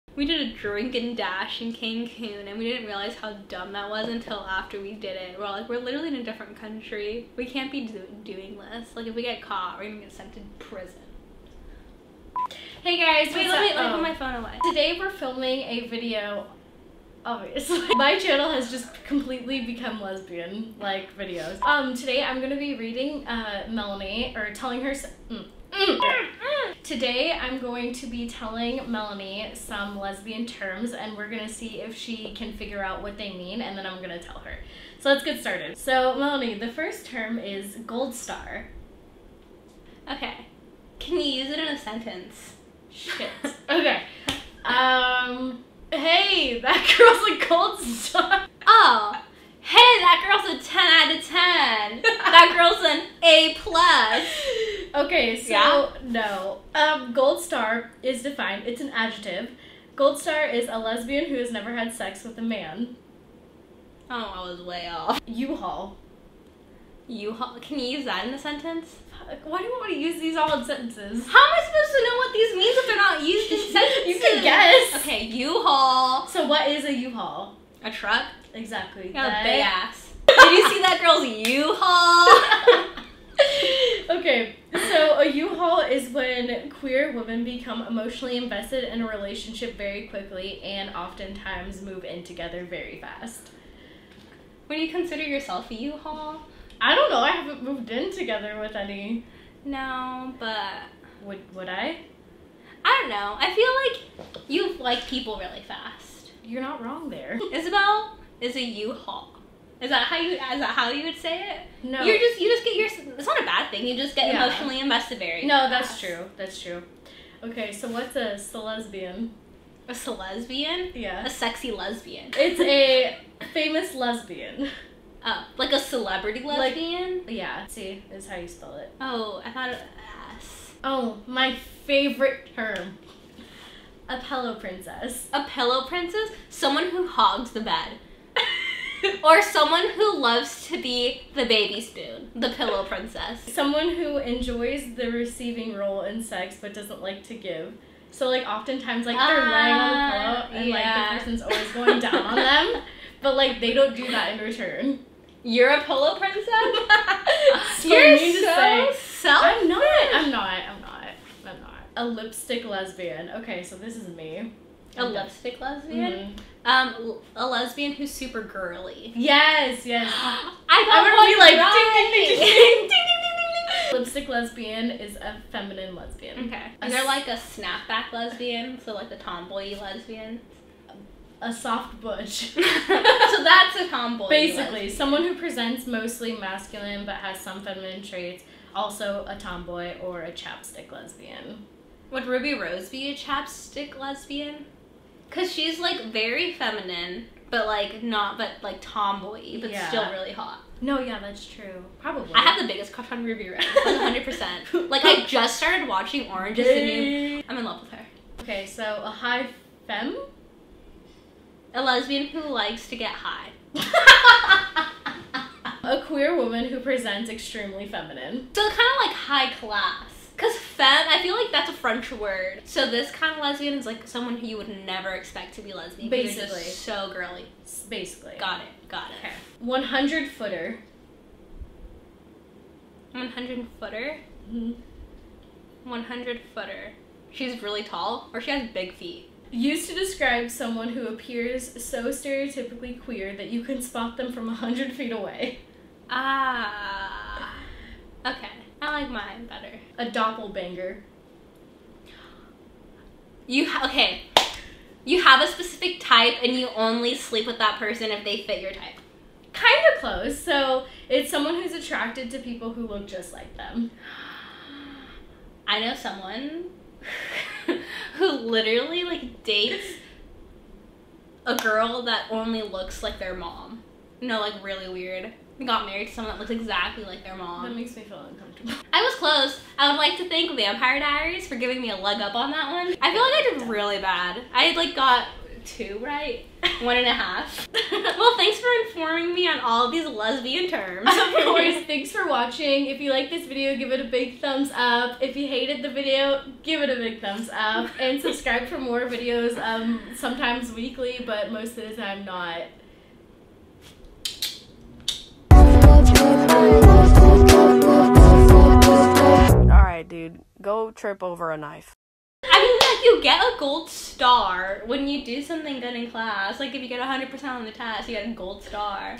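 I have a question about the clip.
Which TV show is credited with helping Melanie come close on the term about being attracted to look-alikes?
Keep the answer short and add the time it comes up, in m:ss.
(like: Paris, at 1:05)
Vampire Diaries, at 4:40.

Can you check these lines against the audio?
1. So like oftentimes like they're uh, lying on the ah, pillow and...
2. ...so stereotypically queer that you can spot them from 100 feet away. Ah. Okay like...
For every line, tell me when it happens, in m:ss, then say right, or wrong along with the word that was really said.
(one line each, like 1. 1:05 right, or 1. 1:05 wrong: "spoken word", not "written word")
1. 2:28 right
2. 4:01 right.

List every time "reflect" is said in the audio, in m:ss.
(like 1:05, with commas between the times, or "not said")
not said.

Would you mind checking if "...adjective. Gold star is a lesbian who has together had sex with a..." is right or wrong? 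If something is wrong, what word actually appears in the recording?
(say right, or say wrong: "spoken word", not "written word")
wrong: "never", not "together".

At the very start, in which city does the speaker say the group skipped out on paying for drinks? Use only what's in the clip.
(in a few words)
Cancun.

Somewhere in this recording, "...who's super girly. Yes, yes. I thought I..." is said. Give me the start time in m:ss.
2:47.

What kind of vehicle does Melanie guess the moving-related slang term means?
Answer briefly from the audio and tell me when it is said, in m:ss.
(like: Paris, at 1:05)
A truck, at 1:17.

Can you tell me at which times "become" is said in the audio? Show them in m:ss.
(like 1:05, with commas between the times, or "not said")
0:19, 1:27.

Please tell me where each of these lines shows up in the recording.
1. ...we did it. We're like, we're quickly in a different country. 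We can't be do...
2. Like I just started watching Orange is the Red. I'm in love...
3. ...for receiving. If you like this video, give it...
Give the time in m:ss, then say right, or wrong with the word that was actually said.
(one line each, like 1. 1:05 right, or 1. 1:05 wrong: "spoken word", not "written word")
1. 0:04 wrong: "literally", not "quickly"
2. 3:24 wrong: "New", not "Red"
3. 4:52 wrong: "watching", not "receiving".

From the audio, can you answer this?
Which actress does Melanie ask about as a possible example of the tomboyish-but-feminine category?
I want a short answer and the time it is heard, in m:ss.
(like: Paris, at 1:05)
Ruby Rose, at 3:12.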